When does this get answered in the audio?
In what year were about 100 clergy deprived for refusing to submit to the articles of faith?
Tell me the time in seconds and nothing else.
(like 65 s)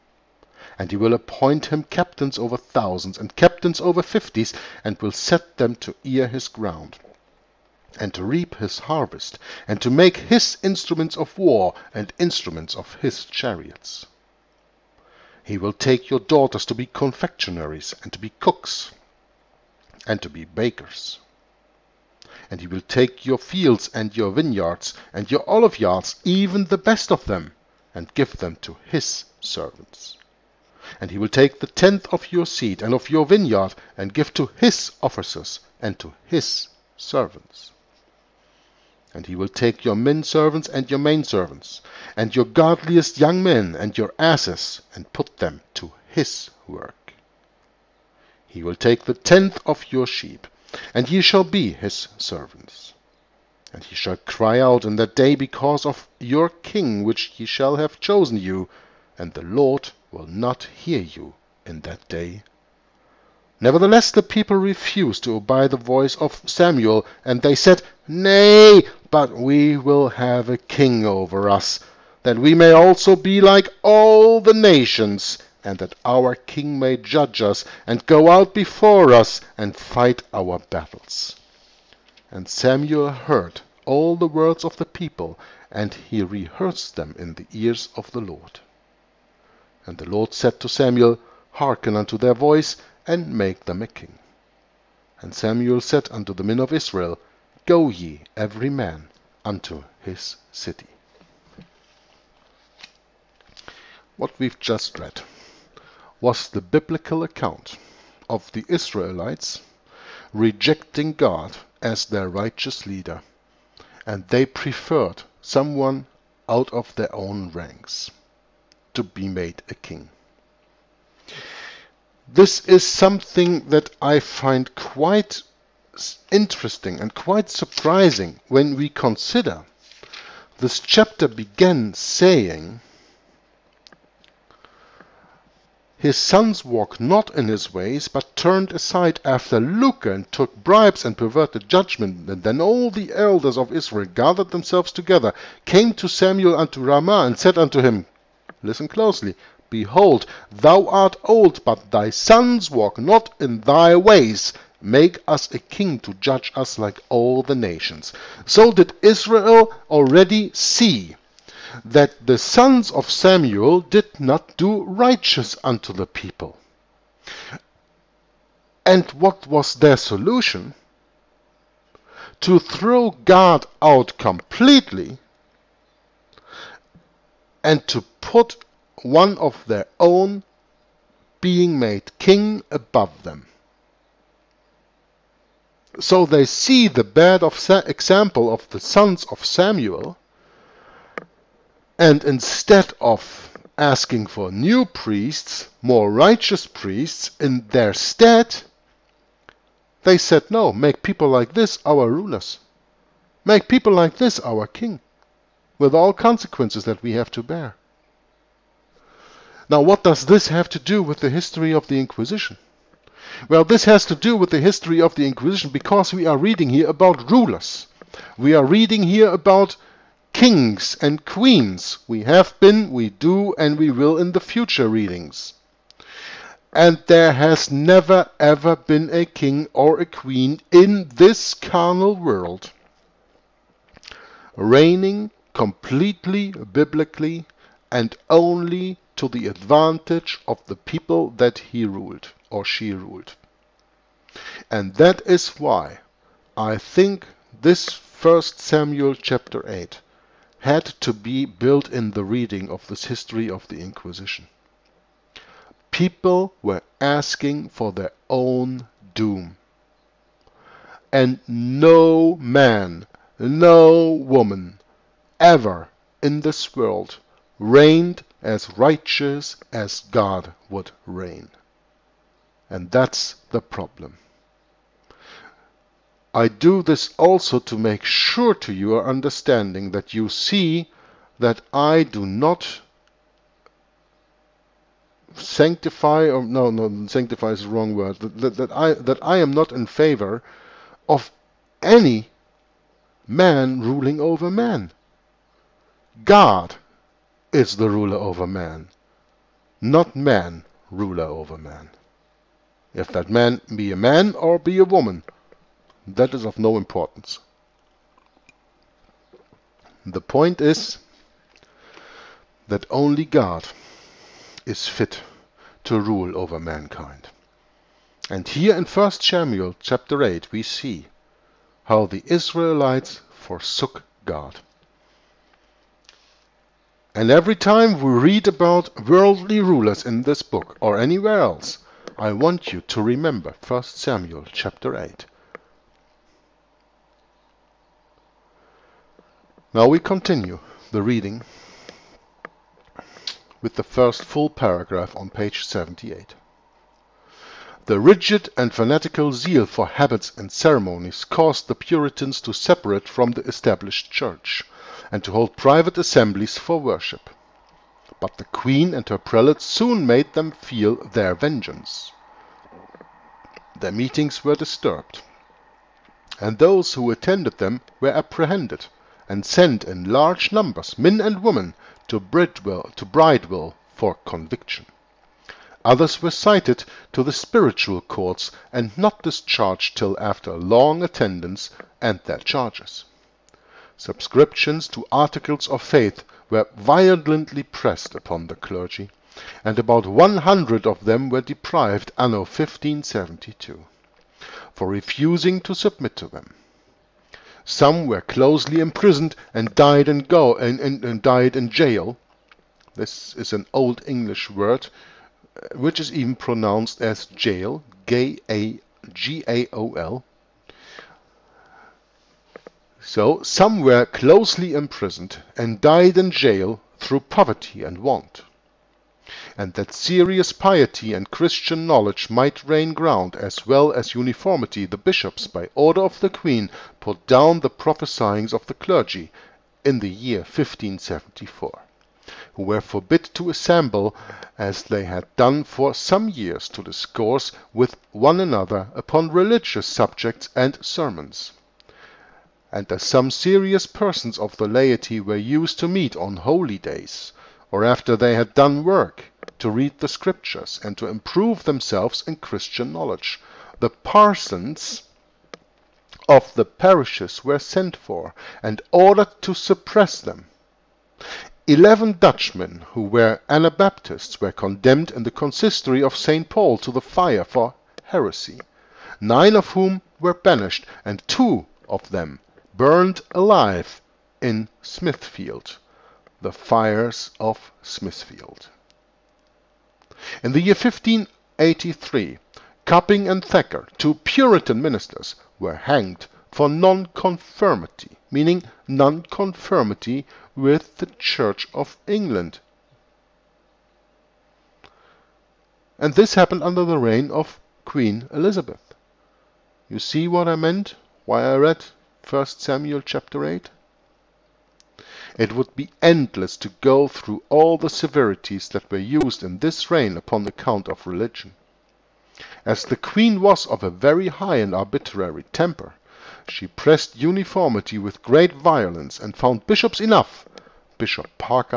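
392 s.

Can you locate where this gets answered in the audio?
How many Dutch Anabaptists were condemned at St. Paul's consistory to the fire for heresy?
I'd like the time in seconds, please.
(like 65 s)
461 s.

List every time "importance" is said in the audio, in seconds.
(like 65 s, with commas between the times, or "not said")
306 s.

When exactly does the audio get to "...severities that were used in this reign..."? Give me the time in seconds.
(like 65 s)
507 s.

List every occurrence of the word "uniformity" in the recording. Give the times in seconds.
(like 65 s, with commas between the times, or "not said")
424 s, 517 s.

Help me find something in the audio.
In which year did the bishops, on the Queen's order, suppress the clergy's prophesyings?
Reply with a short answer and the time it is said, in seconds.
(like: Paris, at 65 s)
1574, at 430 s.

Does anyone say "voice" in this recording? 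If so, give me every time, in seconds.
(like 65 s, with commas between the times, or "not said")
65 s, 92 s.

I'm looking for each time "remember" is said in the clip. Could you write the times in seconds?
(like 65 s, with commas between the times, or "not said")
333 s.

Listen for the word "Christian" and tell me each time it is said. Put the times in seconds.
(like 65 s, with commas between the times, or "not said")
421 s, 452 s.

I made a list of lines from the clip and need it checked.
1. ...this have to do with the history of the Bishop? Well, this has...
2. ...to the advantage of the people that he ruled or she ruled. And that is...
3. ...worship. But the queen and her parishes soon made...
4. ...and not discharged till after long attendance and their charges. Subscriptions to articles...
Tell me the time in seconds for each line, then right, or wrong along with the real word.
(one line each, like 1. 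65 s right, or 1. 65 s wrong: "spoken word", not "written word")
1. 210 s wrong: "Inquisition", not "Bishop"
2. 239 s right
3. 356 s wrong: "prelates", not "parishes"
4. 378 s right.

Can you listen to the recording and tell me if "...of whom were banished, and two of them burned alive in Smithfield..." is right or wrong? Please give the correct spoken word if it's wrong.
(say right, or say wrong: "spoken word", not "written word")
right.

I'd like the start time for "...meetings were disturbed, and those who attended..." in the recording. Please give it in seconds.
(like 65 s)
363 s.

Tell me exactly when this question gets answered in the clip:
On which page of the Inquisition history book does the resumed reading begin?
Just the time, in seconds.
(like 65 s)
345 s.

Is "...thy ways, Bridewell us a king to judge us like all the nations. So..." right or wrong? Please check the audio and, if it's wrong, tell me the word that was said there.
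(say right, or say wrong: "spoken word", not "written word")
wrong: "Make", not "Bridewell".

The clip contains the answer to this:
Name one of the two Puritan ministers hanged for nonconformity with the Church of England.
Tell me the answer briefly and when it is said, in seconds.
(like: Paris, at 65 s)
Copping, at 482 s.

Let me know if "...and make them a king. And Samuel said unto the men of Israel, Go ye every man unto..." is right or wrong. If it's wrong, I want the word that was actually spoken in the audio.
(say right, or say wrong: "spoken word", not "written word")
right.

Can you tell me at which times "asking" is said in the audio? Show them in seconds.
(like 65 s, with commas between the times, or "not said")
193 s, 257 s.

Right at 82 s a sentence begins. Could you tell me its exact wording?
And Samuel heard all the words of the people, and he rehearsed them in the ears of the Lord.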